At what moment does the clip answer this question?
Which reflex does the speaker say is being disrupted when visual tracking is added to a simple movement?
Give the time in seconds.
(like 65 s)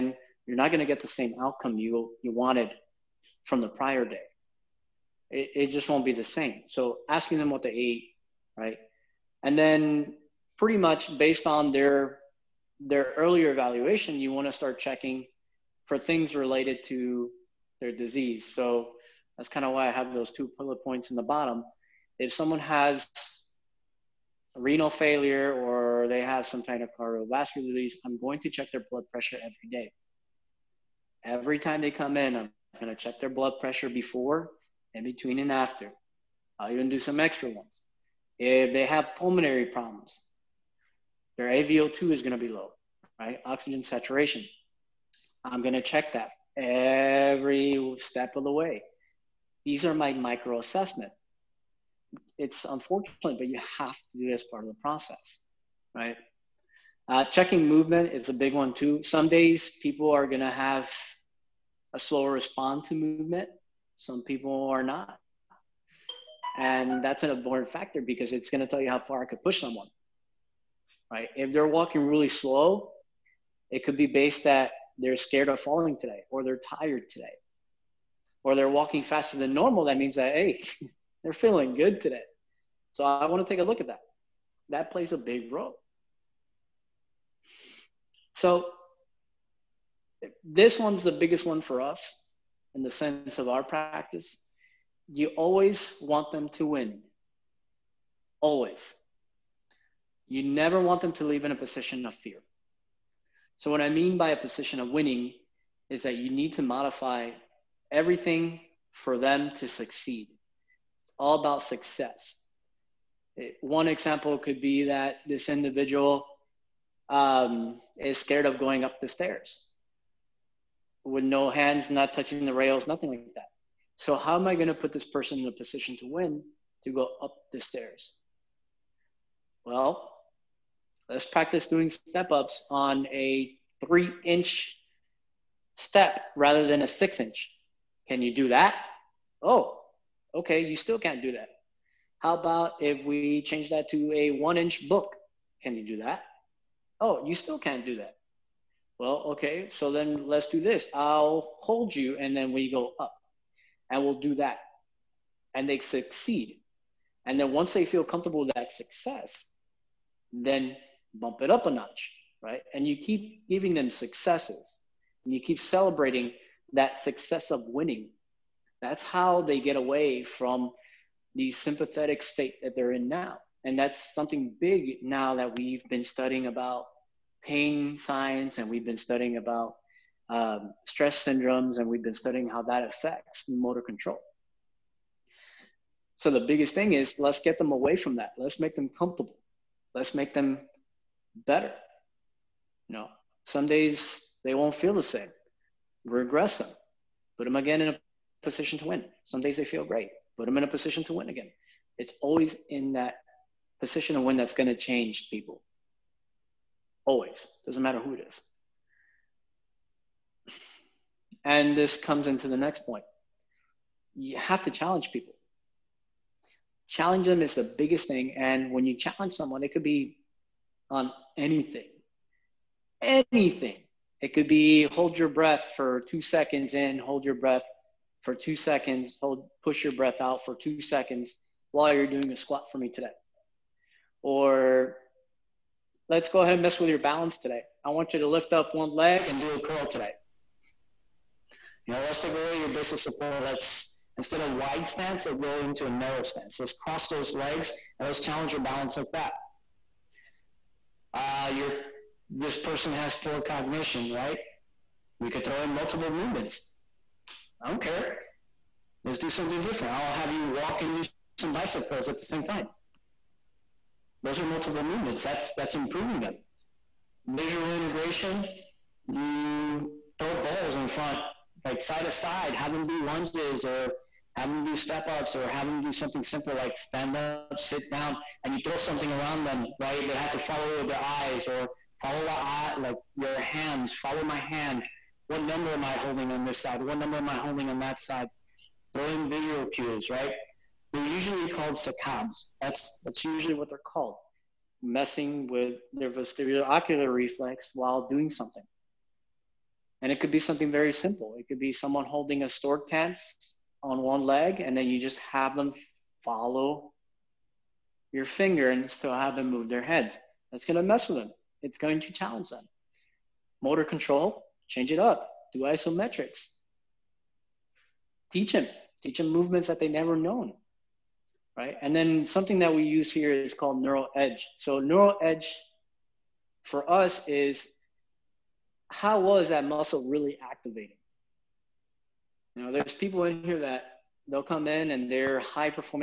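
296 s.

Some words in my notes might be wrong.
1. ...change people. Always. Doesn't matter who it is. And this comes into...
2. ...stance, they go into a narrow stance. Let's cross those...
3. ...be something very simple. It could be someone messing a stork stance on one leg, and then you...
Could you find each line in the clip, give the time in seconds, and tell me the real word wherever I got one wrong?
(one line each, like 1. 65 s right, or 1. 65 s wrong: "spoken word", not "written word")
1. 204 s right
2. 244 s right
3. 300 s wrong: "holding", not "messing".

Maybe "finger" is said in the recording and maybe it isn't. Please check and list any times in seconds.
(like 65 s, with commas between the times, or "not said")
308 s.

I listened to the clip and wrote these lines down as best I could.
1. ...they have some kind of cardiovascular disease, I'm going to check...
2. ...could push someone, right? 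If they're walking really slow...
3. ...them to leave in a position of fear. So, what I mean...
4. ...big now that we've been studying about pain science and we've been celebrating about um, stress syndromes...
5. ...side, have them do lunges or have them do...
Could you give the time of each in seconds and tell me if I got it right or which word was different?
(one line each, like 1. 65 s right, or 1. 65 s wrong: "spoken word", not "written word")
1. 26 s right
2. 69 s right
3. 101 s right
4. 174 s wrong: "studying", not "celebrating"
5. 272 s right.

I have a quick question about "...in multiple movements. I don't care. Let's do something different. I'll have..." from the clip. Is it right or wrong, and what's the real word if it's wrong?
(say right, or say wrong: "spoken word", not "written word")
right.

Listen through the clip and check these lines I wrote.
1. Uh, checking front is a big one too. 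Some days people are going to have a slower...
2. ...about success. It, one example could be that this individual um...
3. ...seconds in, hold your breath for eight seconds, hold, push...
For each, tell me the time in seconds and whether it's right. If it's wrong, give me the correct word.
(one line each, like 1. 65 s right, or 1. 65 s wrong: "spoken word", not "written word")
1. 57 s wrong: "movement", not "front"
2. 111 s right
3. 226 s wrong: "two", not "eight".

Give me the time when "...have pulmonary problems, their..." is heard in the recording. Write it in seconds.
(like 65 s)
38 s.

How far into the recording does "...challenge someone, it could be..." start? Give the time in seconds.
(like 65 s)
218 s.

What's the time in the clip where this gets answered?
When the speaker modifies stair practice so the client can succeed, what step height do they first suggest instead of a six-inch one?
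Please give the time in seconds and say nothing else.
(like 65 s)
133 s.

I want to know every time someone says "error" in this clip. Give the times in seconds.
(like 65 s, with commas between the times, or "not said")
not said.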